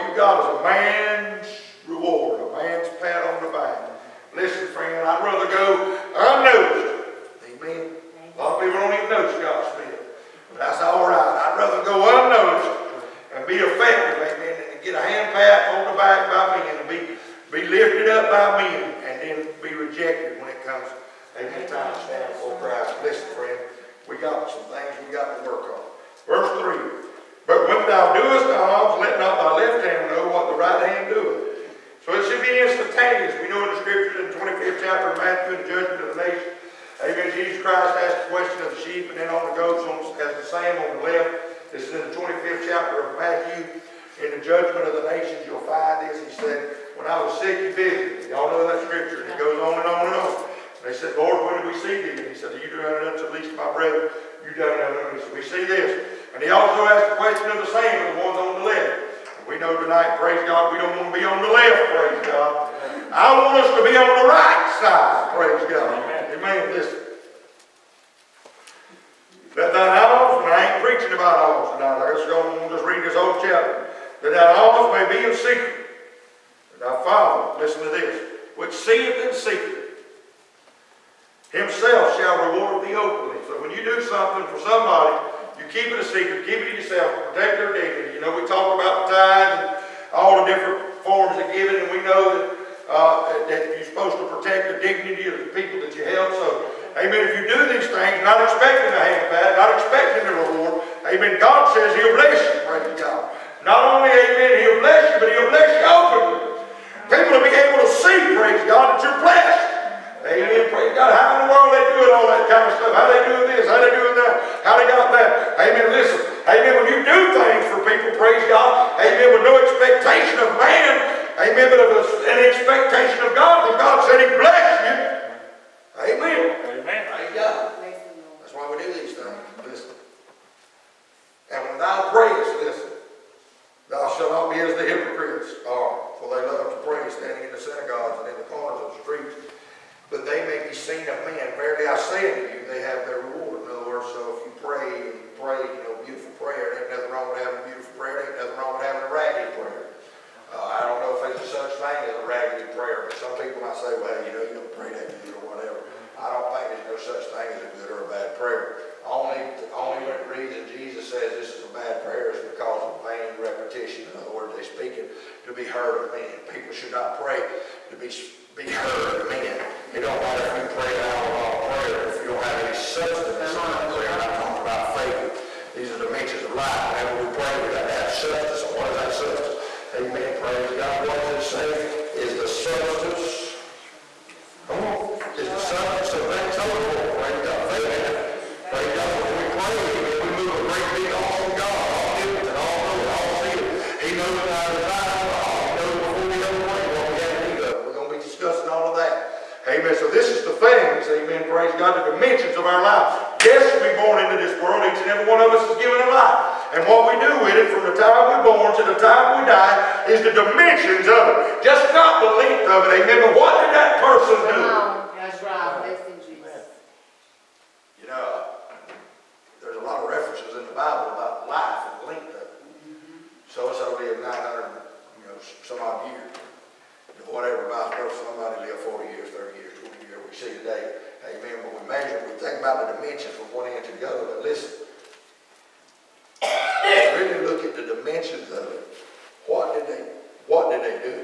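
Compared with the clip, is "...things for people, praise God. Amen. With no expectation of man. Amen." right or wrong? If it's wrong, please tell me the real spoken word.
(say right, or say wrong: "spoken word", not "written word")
right.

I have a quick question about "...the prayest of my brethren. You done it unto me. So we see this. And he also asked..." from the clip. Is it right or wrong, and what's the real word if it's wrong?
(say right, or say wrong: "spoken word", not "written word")
wrong: "least", not "prayest".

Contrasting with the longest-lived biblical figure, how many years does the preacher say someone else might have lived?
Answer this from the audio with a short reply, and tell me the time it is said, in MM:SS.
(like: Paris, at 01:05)
40, at 03:48.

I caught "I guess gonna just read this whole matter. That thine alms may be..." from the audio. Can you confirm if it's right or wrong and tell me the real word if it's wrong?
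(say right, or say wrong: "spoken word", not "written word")
wrong: "chapter", not "matter".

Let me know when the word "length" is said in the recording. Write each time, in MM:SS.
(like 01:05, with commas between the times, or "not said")
03:32, 03:42.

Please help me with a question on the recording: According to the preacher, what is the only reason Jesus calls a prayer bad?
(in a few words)
vain repetition.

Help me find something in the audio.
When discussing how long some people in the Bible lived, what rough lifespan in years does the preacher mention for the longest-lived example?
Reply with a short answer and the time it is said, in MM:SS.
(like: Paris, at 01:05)
900, at 03:44.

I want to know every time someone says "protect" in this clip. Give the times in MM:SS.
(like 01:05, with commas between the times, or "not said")
01:27, 01:34.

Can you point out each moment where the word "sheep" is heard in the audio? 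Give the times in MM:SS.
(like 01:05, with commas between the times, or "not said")
00:38.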